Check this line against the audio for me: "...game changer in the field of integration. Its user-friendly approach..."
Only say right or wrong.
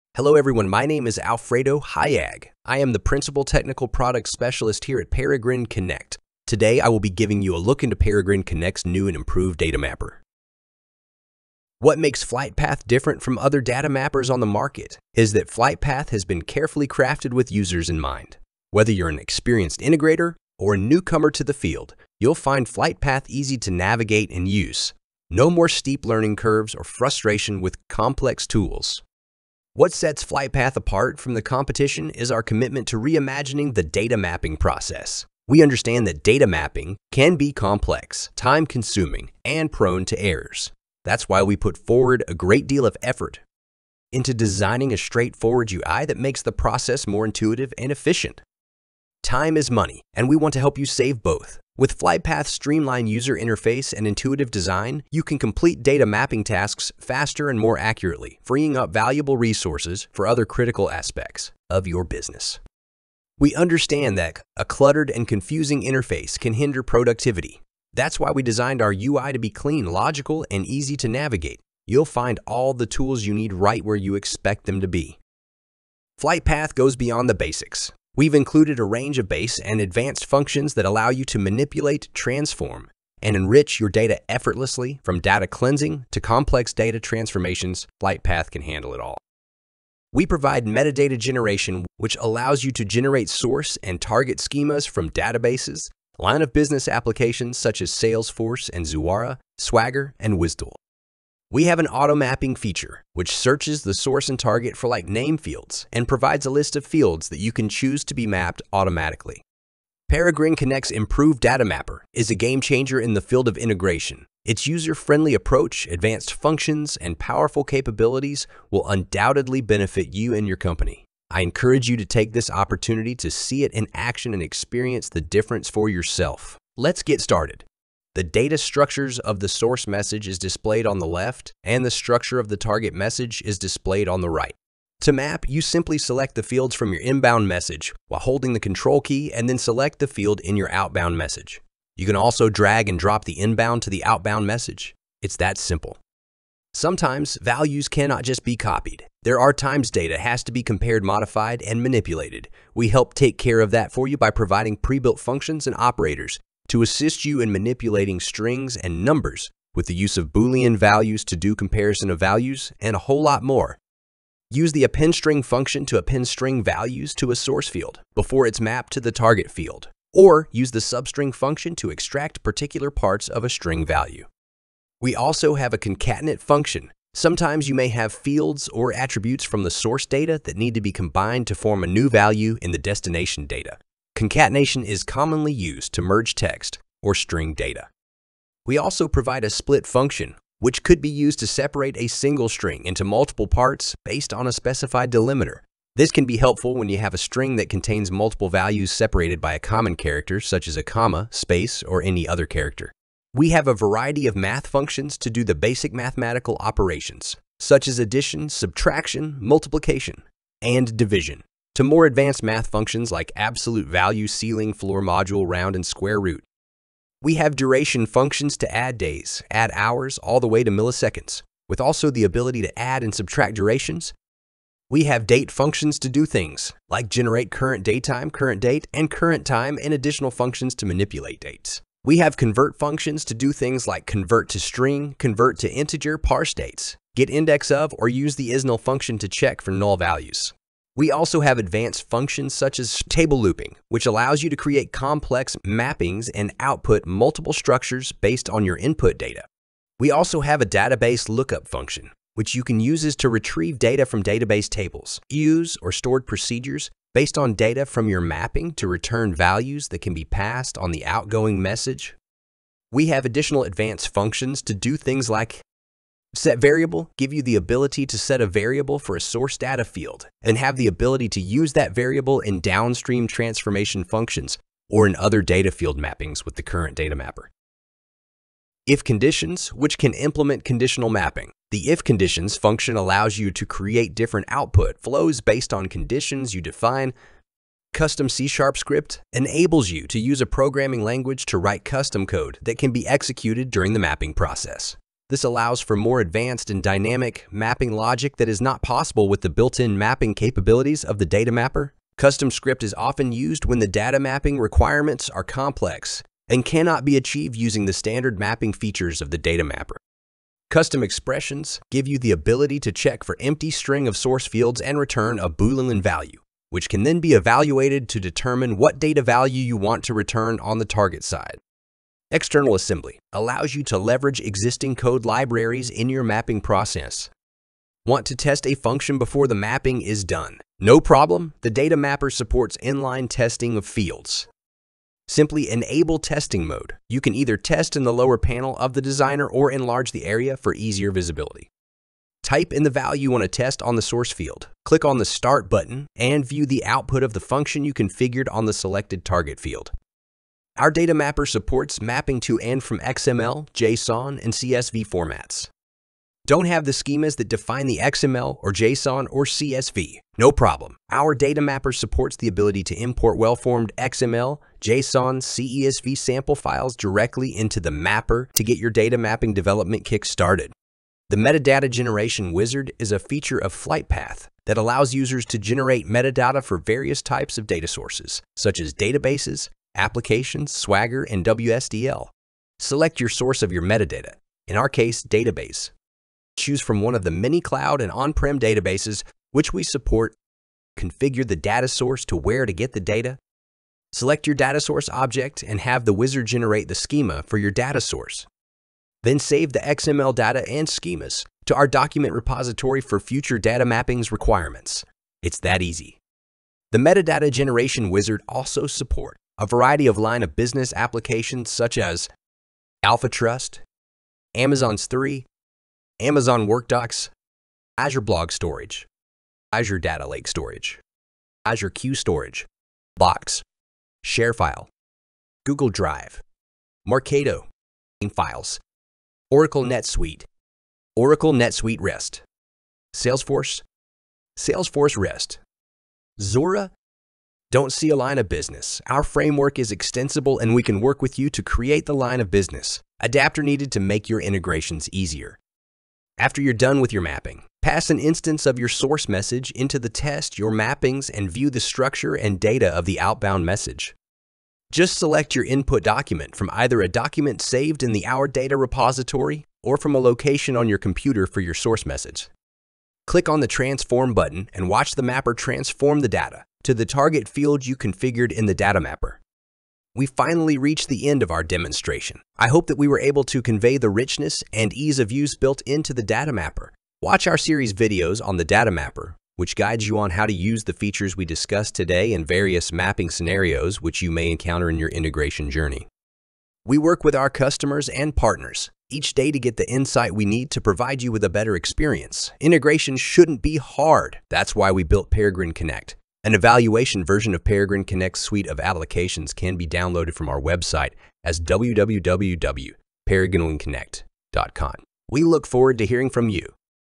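right.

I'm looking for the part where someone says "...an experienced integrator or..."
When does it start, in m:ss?
0:19.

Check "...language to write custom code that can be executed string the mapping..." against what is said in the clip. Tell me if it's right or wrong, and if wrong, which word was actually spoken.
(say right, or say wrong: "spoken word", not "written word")
wrong: "during", not "string".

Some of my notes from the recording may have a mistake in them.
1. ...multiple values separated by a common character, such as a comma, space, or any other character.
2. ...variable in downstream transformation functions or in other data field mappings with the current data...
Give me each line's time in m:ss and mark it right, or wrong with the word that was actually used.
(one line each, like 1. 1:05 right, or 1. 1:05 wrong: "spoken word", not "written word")
1. 3:18 right
2. 4:31 right.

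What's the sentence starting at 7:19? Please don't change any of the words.
Our framework is extensible and we can work with you to create the line of business.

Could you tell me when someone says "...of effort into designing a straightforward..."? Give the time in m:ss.
0:42.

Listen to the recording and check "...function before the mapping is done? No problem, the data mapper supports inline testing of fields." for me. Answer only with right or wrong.
right.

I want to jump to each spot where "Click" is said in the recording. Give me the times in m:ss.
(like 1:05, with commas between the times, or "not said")
5:44, 7:43.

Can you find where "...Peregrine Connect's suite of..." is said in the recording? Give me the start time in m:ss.
8:17.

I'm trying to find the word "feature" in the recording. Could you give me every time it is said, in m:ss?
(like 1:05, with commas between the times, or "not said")
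1:42, 5:08, 6:13, 8:00.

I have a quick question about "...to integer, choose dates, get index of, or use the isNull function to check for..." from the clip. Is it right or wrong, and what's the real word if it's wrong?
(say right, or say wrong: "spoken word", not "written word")
wrong: "parse", not "choose".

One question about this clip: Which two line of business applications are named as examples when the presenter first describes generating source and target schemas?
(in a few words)
Salesforce and Zuora.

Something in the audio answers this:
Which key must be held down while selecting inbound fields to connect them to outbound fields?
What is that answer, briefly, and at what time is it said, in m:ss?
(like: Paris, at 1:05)
Control, at 2:18.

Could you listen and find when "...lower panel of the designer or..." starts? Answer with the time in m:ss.
5:38.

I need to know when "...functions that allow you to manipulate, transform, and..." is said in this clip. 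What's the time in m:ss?
1:20.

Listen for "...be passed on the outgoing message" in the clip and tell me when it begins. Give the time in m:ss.
4:20.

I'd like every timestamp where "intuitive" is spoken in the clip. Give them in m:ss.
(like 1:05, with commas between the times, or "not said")
0:47, 0:54.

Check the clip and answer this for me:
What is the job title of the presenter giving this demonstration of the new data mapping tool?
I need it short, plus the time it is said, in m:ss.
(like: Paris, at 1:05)
Principal Technical Product Specialist, at 0:02.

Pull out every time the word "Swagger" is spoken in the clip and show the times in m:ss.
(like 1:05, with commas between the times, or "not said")
1:39, 6:20.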